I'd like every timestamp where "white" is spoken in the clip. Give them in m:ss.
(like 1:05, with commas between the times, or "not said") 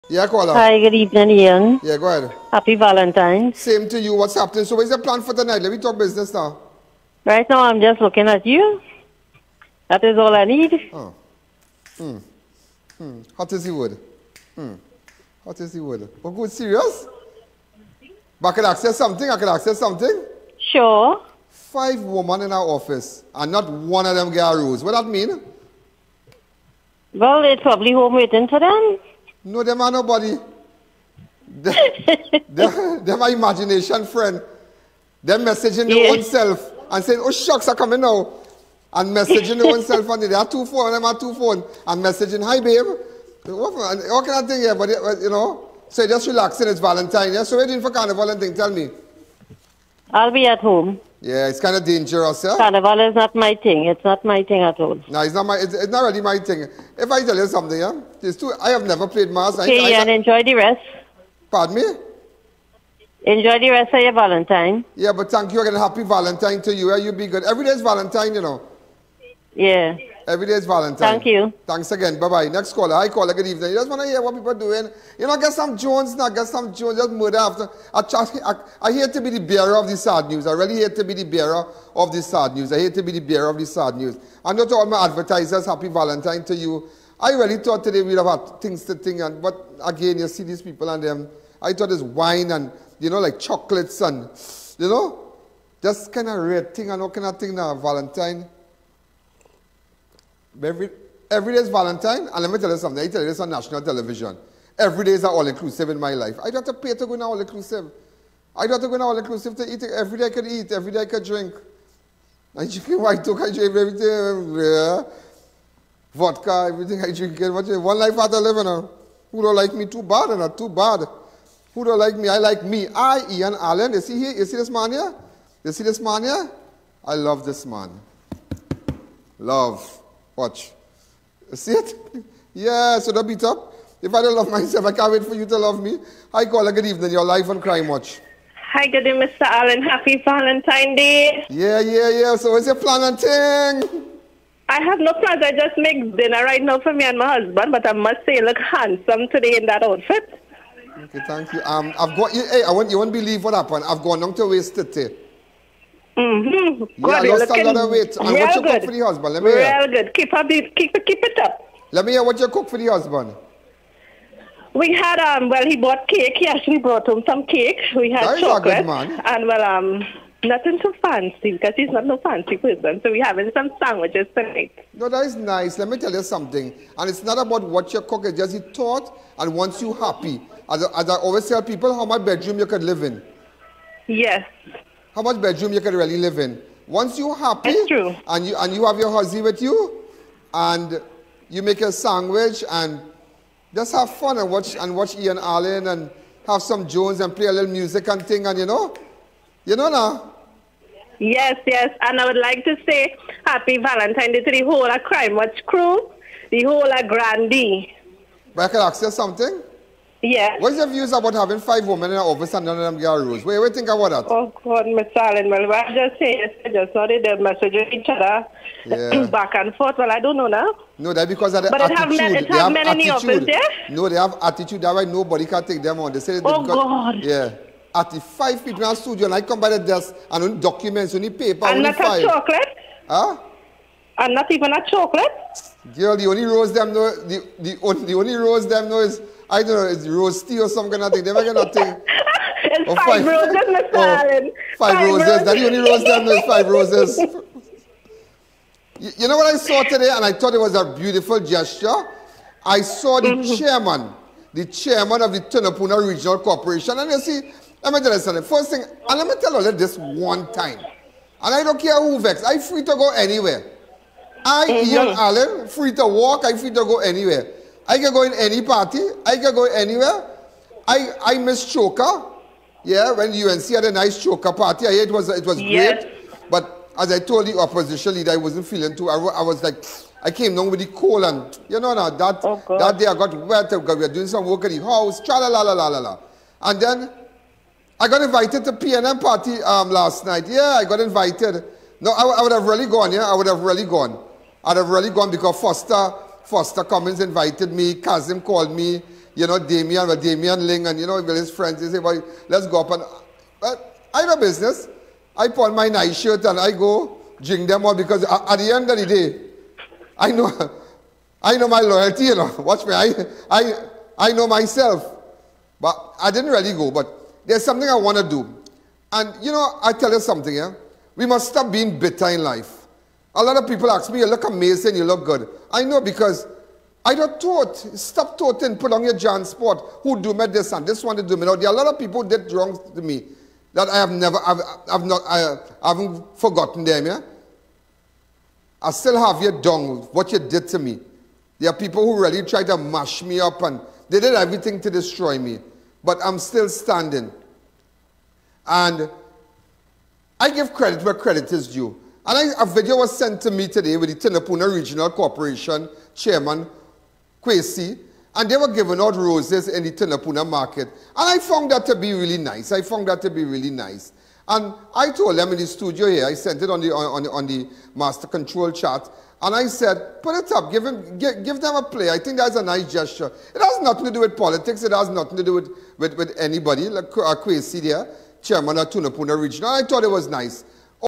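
1:53.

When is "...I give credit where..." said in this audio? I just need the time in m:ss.
5:50.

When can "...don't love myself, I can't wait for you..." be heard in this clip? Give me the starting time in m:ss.
2:14.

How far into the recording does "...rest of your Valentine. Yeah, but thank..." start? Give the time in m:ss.
1:03.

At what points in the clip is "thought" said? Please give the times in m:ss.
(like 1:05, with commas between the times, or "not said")
1:27, 1:31, 2:58, 4:10, 6:19.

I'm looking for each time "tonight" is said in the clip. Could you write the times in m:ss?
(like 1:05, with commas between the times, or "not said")
0:05, 2:54.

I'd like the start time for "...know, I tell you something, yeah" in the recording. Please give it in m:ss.
5:19.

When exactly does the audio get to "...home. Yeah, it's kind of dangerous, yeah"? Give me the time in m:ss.
0:50.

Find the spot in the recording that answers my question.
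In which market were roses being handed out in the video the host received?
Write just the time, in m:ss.
5:59.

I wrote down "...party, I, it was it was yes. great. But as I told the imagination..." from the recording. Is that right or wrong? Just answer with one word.
wrong.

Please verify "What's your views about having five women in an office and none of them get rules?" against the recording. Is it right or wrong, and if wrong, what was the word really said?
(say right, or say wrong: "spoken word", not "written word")
right.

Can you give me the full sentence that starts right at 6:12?
I think that's a nice gesture.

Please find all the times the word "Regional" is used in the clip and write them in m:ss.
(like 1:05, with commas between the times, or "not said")
4:16, 5:54, 6:19.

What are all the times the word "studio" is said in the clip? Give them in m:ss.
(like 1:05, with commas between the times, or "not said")
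3:48, 6:05.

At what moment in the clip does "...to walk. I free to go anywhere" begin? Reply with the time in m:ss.
4:25.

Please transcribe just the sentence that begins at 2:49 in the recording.
And well um nothing too fancy because he's not no fancy person.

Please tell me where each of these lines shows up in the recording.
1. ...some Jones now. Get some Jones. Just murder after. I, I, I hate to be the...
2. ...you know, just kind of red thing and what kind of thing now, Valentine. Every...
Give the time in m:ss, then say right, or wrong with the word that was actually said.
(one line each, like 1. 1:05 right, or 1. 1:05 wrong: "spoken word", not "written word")
1. 1:15 right
2. 1:34 right.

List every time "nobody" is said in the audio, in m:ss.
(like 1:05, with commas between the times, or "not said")
0:29, 3:45.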